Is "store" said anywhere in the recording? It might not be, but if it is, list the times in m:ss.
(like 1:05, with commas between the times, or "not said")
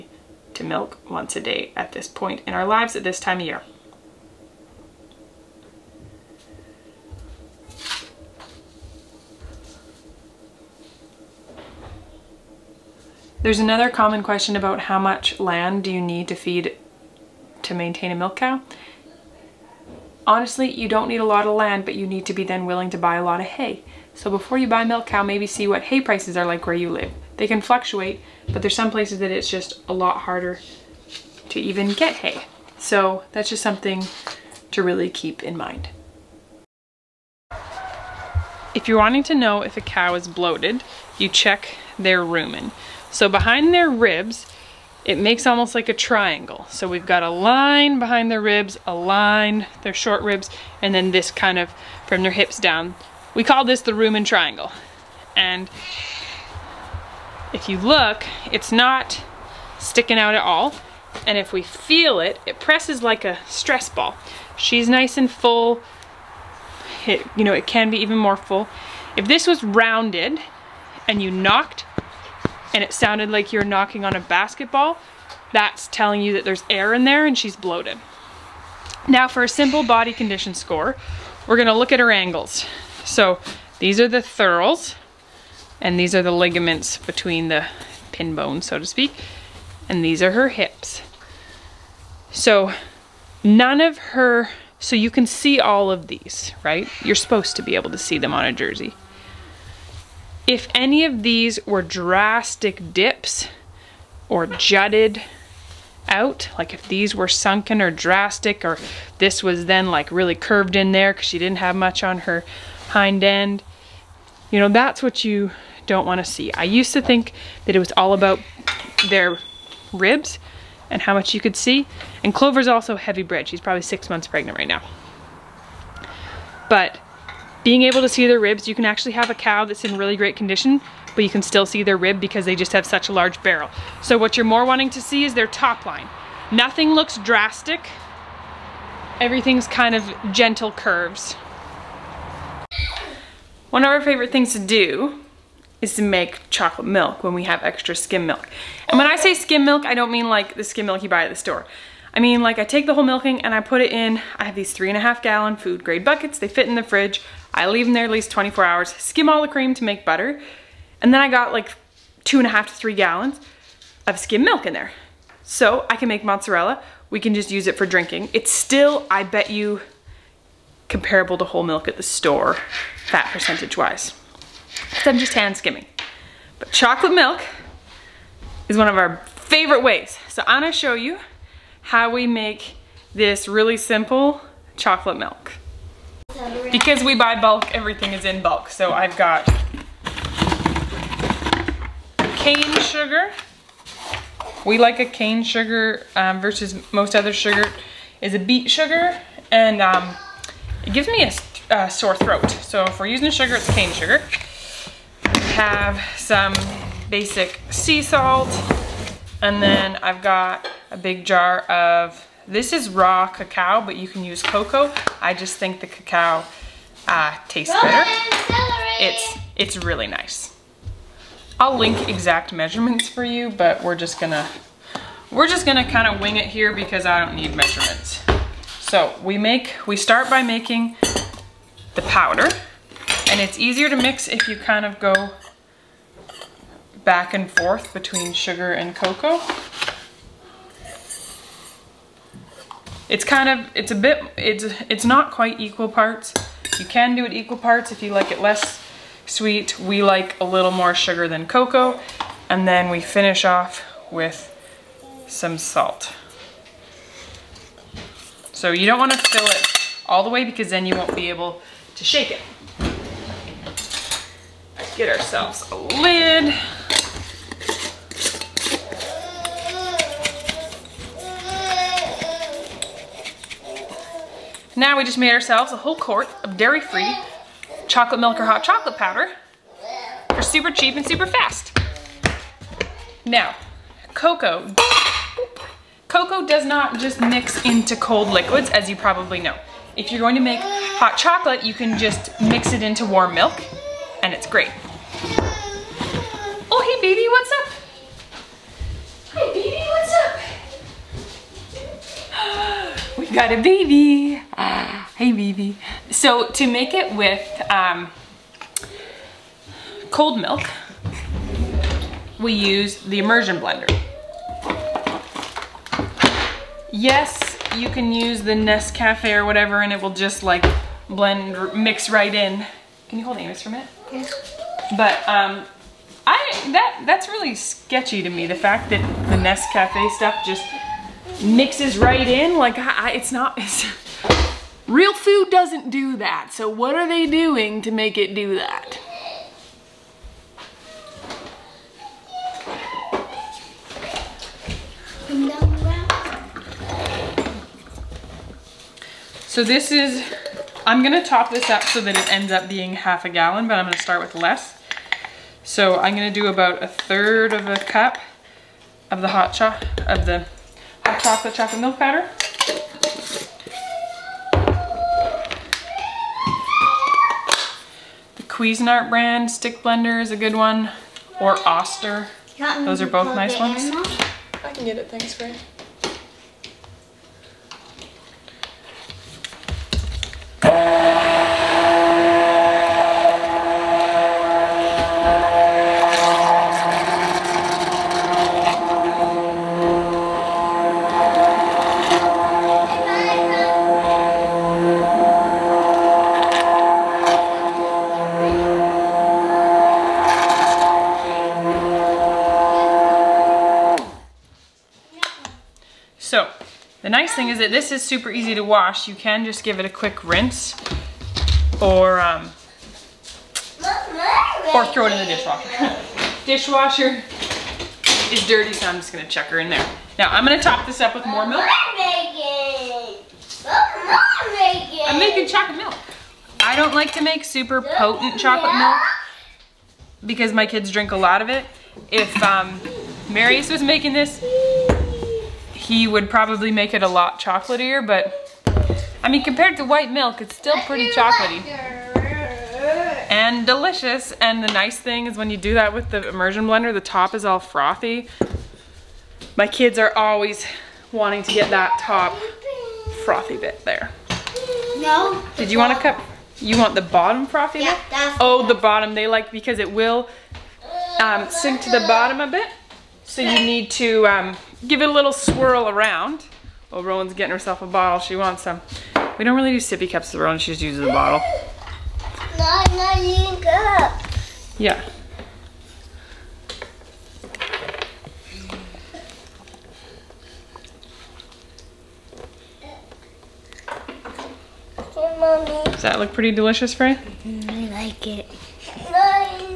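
2:31, 2:52.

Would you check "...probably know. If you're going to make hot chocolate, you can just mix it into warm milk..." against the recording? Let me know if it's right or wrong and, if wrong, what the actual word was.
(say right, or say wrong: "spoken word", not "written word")
right.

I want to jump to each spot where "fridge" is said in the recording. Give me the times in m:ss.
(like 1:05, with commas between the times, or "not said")
2:36.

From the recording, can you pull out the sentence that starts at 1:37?
You're supposed to be able to see them on a jersey.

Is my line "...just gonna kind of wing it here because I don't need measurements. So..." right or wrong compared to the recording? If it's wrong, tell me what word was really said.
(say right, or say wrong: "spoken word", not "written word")
right.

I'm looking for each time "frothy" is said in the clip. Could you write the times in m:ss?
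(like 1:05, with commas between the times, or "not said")
7:27, 7:33, 7:37.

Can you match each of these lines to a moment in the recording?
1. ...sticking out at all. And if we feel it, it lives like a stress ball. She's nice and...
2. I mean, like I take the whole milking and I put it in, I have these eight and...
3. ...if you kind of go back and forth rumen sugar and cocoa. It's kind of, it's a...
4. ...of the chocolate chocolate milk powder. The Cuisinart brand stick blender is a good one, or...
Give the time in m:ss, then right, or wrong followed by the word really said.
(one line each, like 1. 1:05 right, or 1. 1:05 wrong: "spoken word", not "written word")
1. 0:59 wrong: "presses", not "lives"
2. 2:32 wrong: "three", not "eight"
3. 3:54 wrong: "between", not "rumen"
4. 6:00 right.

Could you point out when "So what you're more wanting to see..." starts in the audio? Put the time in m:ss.
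2:14.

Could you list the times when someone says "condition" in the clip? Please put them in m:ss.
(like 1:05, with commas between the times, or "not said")
1:20, 2:10.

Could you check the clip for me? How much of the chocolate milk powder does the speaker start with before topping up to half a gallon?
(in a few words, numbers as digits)
1/3 cup.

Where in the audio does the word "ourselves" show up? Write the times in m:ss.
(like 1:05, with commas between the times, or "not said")
4:25, 4:35.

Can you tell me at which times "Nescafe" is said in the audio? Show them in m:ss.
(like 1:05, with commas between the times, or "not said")
5:18, 5:29.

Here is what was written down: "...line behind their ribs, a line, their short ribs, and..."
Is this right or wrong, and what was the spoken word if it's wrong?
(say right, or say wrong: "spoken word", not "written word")
right.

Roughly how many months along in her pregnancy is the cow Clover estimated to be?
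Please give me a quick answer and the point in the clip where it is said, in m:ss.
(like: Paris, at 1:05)
6, at 2:03.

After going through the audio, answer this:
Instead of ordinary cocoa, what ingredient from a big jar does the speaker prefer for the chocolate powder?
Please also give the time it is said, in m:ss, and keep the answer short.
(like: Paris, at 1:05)
raw cacao, at 3:32.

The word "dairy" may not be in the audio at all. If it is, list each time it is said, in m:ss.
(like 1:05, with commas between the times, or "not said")
4:36.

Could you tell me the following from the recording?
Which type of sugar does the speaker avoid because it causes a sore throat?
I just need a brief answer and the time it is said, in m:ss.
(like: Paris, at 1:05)
beet sugar, at 3:18.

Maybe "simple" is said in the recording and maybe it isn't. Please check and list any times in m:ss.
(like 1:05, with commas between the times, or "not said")
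1:19, 3:03.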